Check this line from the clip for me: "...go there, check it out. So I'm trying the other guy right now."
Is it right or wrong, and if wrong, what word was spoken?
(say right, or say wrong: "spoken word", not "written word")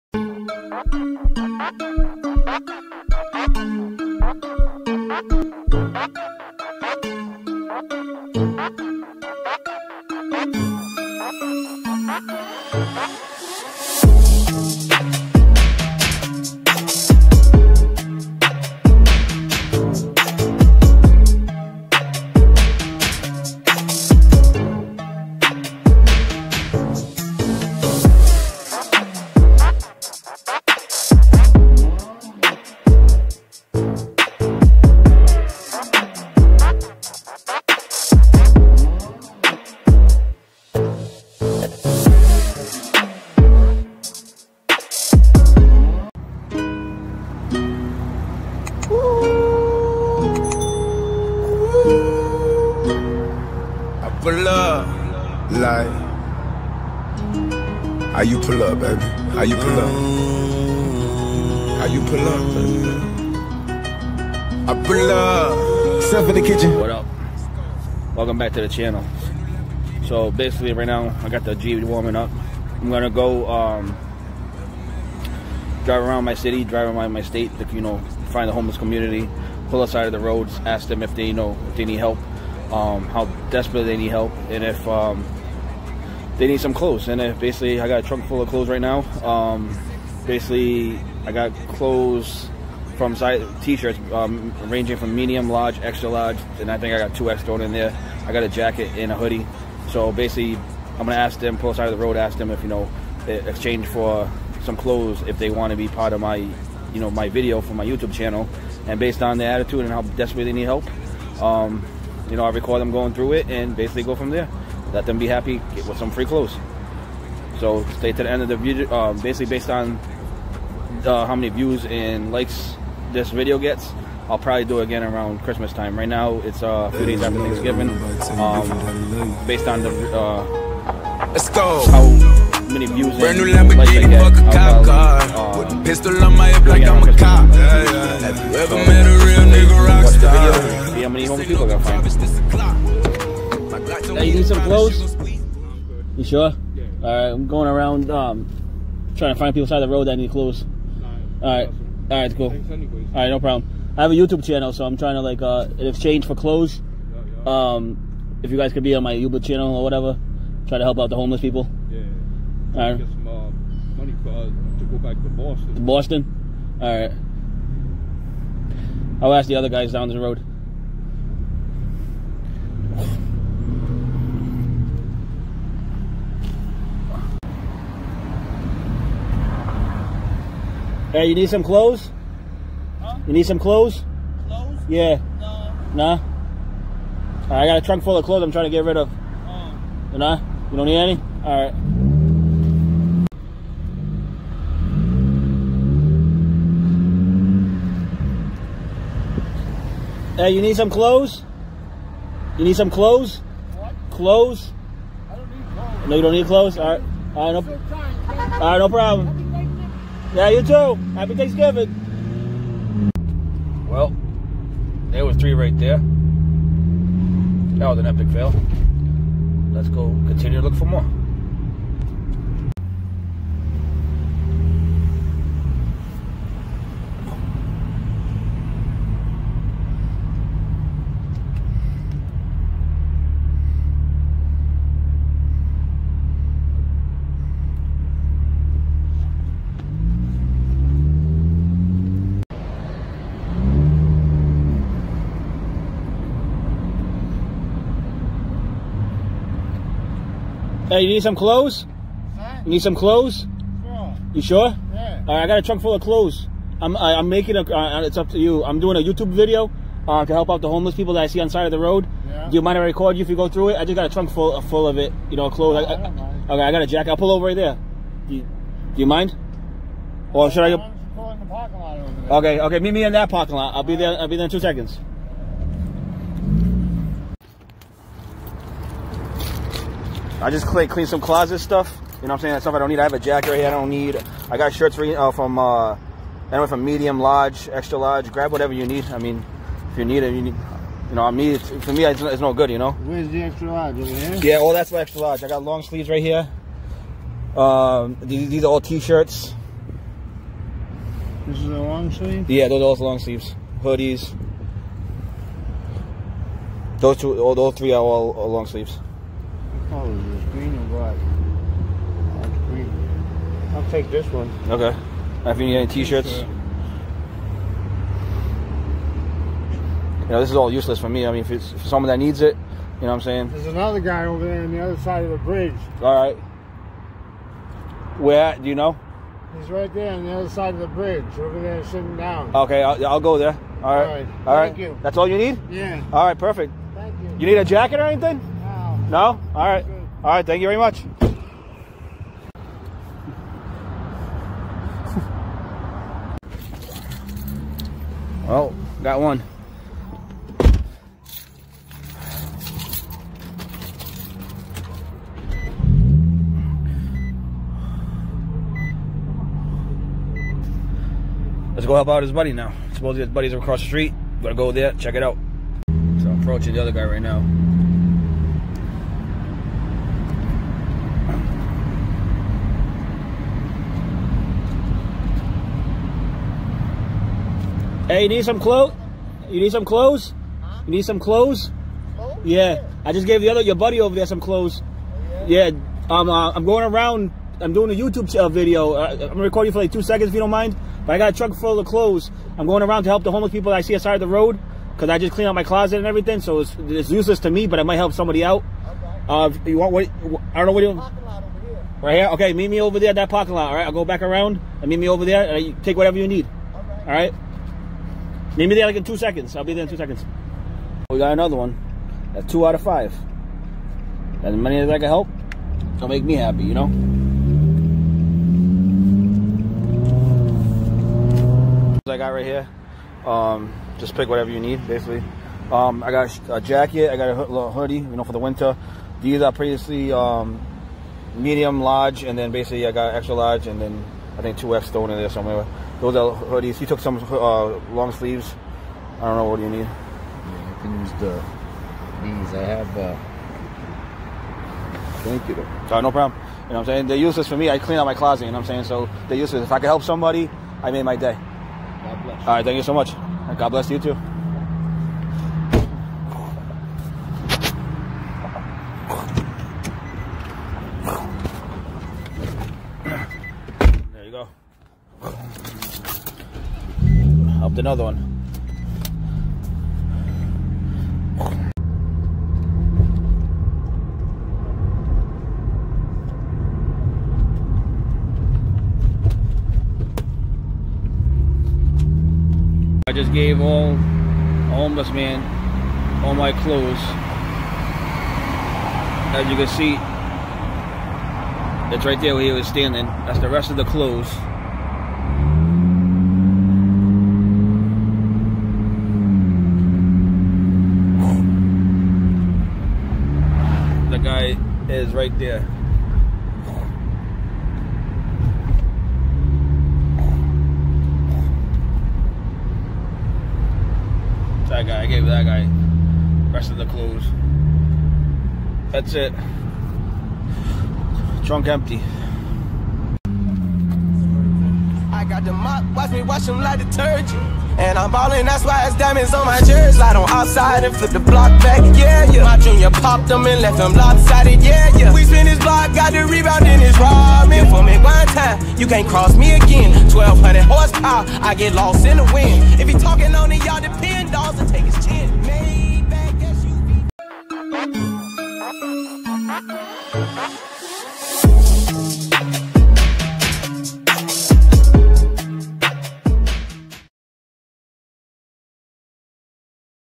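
wrong: "approaching", not "trying".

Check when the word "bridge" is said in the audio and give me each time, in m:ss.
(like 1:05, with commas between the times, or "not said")
5:25, 5:30.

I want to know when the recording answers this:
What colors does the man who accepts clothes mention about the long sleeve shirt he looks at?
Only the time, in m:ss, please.
5:10.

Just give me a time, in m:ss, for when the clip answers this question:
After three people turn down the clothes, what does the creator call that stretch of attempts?
3:38.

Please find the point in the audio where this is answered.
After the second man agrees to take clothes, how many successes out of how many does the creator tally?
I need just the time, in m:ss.
6:52.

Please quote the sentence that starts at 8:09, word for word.
As you can see, that's right there where he was standing.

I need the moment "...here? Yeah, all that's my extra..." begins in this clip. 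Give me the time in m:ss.
4:54.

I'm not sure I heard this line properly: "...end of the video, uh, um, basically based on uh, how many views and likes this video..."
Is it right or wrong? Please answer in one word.
right.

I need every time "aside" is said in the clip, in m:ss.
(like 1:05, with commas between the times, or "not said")
6:33.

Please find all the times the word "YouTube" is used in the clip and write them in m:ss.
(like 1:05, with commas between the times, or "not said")
1:47, 2:34, 2:39, 4:18, 6:27.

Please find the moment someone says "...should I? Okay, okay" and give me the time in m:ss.
4:30.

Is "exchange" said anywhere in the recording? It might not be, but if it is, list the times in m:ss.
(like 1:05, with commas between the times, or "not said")
1:43, 2:35.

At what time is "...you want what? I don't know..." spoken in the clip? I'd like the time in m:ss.
6:39.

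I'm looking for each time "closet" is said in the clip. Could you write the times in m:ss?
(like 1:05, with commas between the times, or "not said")
4:41, 6:35, 7:28.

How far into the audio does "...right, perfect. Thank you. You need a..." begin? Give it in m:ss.
5:36.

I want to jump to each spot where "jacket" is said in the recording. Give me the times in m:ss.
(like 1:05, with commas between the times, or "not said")
1:38, 4:26, 4:43, 5:37, 7:06.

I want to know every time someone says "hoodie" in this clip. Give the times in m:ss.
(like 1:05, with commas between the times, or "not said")
1:39, 5:03, 7:07, 7:16.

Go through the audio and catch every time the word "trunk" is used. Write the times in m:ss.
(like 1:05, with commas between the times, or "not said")
1:28, 3:07, 4:15, 4:24, 8:41.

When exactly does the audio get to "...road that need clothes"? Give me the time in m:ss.
2:29.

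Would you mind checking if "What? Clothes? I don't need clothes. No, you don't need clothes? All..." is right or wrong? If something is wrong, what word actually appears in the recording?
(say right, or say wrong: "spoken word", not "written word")
right.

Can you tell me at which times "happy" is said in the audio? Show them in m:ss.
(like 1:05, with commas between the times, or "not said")
1:55, 3:31, 6:56.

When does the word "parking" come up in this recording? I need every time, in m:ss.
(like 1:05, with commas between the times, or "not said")
4:33, 6:43.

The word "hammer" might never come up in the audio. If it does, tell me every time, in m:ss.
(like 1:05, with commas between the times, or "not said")
not said.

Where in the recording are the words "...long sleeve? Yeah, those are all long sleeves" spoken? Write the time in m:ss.
5:01.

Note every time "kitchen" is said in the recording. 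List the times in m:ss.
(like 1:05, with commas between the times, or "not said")
1:06.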